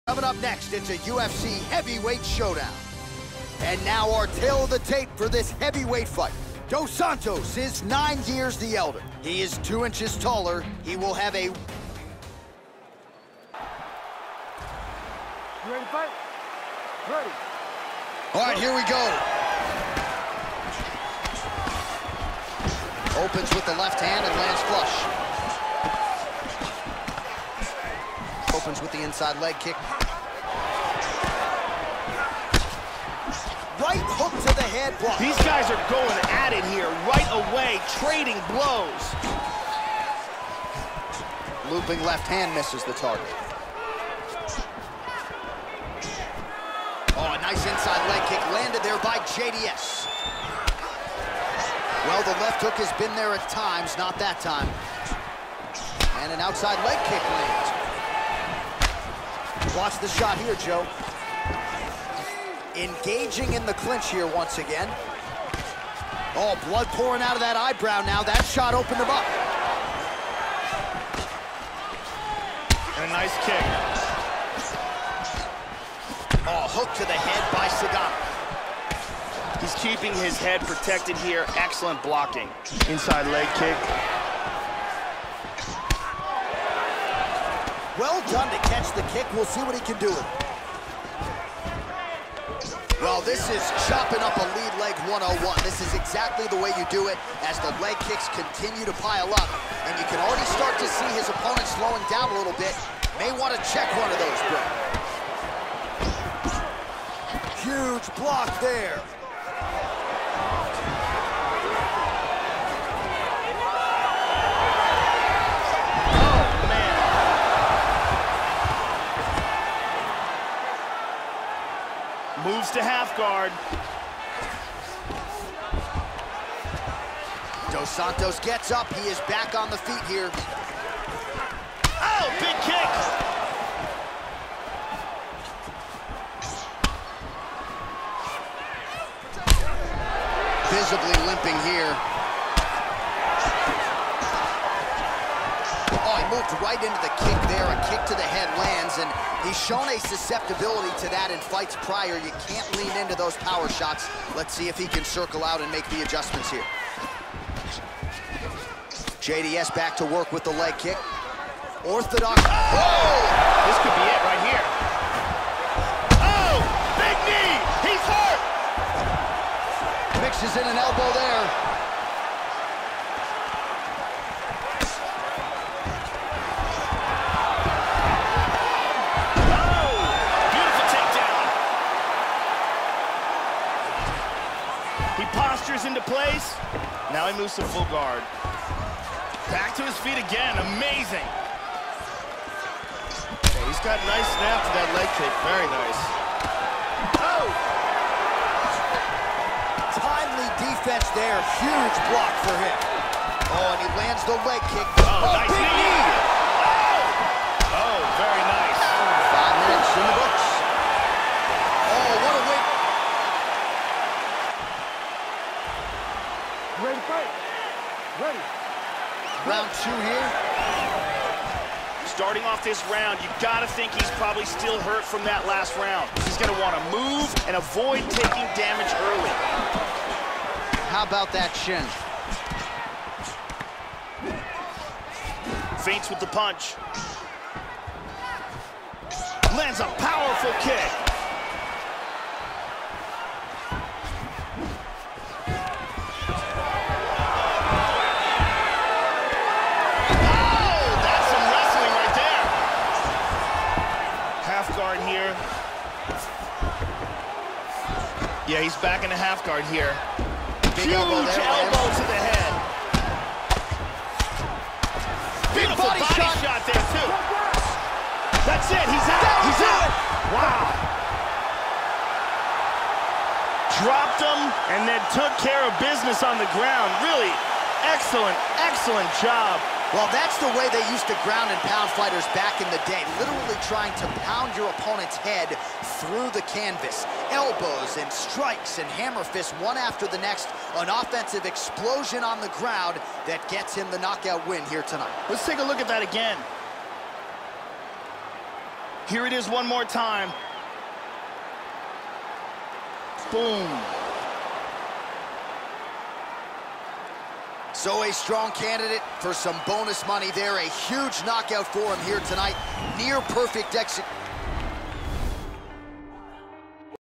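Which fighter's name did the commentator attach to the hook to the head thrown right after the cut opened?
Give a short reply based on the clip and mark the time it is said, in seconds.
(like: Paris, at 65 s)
Sagat, at 78 s.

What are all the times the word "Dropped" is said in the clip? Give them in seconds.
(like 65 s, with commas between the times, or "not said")
273 s.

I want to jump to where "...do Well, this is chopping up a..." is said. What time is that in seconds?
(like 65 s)
90 s.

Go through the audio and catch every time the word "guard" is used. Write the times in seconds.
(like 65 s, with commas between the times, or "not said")
123 s, 187 s, 259 s.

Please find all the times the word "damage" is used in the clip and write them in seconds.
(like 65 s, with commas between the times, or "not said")
228 s.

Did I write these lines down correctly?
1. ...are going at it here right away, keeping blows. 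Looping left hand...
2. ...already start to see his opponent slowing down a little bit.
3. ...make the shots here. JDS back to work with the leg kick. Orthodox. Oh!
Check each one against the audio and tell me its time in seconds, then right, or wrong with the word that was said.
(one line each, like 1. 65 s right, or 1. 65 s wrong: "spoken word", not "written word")
1. 35 s wrong: "trading", not "keeping"
2. 100 s right
3. 155 s wrong: "adjustments", not "shots".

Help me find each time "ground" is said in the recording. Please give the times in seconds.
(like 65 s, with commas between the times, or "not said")
276 s, 281 s, 292 s.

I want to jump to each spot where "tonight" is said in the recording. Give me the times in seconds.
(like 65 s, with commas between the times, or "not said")
294 s, 312 s.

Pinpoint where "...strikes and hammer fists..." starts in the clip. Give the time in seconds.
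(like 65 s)
288 s.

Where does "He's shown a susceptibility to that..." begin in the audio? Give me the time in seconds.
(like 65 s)
149 s.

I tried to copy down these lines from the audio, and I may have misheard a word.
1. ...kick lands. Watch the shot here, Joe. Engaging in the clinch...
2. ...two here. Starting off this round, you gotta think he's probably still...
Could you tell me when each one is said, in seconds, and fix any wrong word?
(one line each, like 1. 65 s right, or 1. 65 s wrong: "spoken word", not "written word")
1. 57 s right
2. 219 s right.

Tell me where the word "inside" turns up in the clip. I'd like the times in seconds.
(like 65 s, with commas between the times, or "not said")
29 s, 47 s, 82 s.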